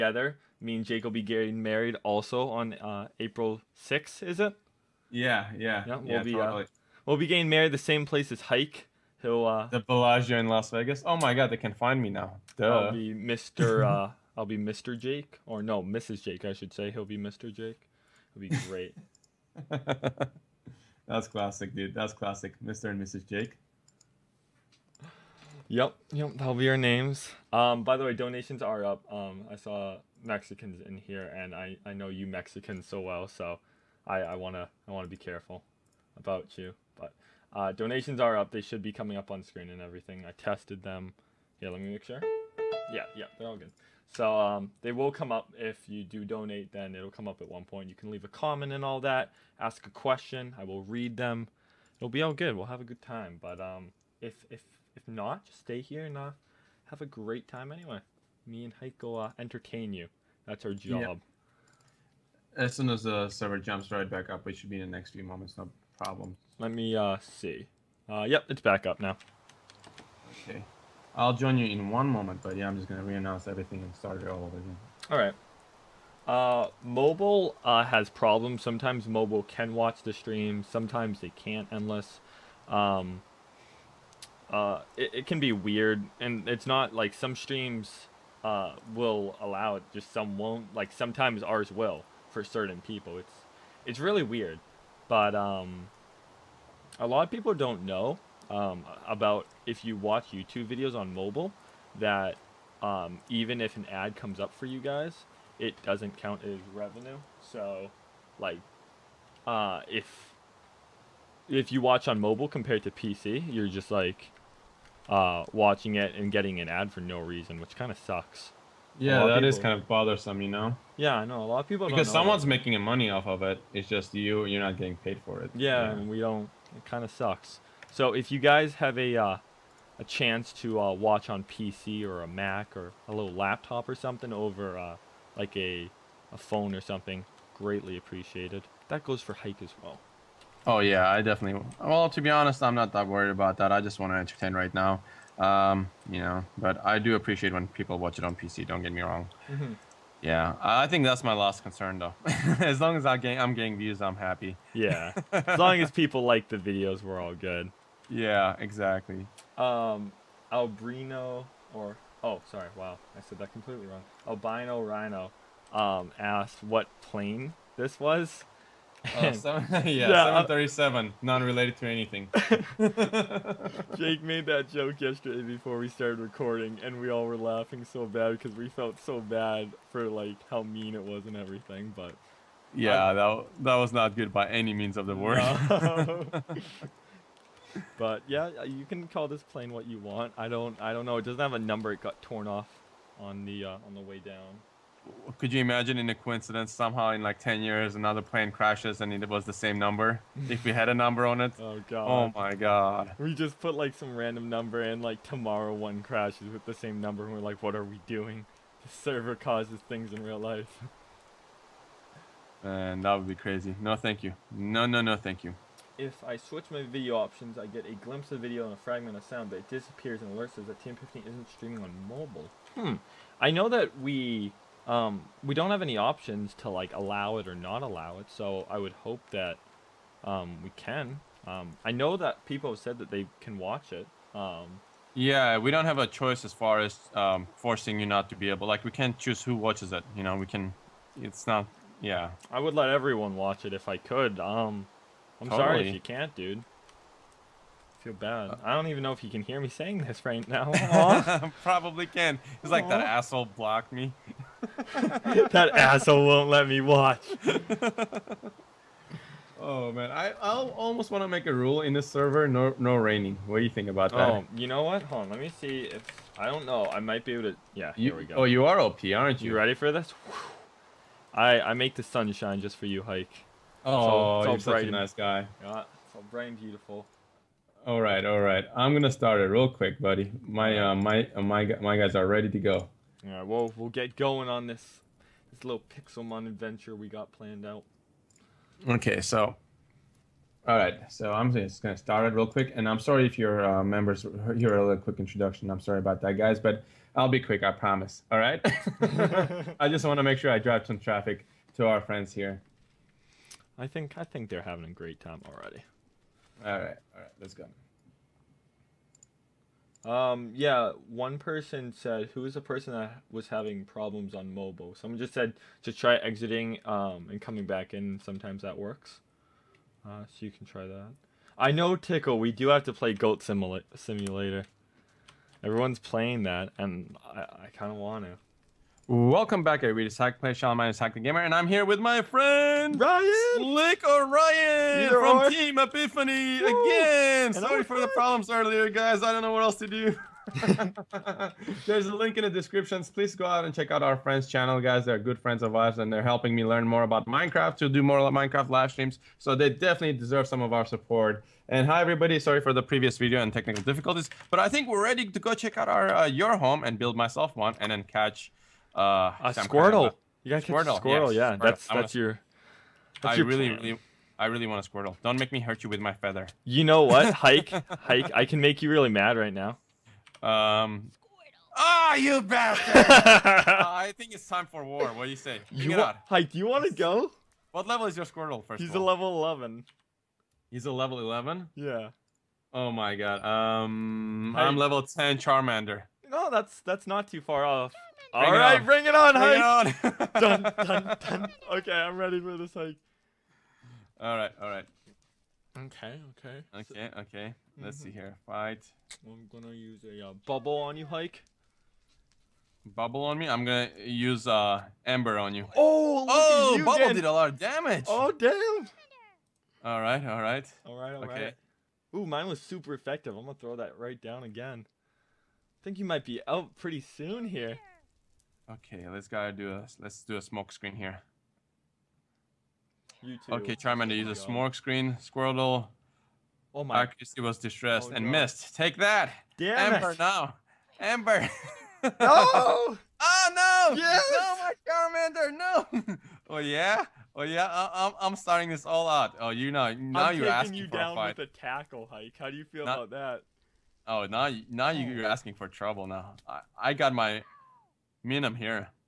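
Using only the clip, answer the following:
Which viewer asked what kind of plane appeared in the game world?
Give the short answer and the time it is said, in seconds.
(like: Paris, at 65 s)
Albino Rhino, at 164 s.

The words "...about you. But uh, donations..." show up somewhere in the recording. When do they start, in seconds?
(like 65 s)
36 s.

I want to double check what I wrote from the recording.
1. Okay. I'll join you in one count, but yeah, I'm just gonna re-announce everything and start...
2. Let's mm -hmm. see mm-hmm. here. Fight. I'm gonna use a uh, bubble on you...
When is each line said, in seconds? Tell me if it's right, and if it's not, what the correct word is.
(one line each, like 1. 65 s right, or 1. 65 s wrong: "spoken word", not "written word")
1. 70 s wrong: "moment", not "count"
2. 397 s right.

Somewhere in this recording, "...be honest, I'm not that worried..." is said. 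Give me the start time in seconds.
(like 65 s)
142 s.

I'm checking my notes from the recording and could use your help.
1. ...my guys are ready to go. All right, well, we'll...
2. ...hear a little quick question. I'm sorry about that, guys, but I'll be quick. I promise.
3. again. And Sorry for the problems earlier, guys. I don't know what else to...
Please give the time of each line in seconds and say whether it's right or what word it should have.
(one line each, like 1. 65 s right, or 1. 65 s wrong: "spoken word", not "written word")
1. 281 s right
2. 294 s wrong: "introduction", not "question"
3. 336 s right.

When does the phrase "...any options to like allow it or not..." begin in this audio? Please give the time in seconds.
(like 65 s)
225 s.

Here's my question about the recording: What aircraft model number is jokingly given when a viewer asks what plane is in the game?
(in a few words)
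737.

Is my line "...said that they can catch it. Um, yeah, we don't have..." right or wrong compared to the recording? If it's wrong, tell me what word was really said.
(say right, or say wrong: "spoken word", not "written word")
wrong: "watch", not "catch".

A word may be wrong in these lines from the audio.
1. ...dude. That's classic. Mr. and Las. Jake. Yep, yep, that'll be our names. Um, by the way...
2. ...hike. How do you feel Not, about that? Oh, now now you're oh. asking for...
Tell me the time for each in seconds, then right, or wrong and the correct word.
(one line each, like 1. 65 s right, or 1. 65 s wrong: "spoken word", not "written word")
1. 21 s wrong: "Mrs", not "Las"
2. 442 s right.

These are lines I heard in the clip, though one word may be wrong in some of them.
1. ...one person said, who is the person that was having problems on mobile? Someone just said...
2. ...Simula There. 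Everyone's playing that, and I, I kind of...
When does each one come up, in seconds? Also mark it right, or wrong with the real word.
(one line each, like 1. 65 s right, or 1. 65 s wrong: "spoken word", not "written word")
1. 311 s right
2. 323 s wrong: "Simulator", not "There".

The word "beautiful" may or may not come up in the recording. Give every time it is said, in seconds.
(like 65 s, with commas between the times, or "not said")
276 s.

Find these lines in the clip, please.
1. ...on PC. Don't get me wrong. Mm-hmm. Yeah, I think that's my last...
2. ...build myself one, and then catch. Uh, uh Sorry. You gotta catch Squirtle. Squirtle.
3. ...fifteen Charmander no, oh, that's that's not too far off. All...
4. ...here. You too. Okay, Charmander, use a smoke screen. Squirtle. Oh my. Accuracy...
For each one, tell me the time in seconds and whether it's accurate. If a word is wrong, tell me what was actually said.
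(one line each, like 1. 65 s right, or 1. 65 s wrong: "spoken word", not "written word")
1. 148 s right
2. 356 s wrong: "Squirtle", not "Sorry"
3. 385 s wrong: "ten", not "fifteen"
4. 420 s right.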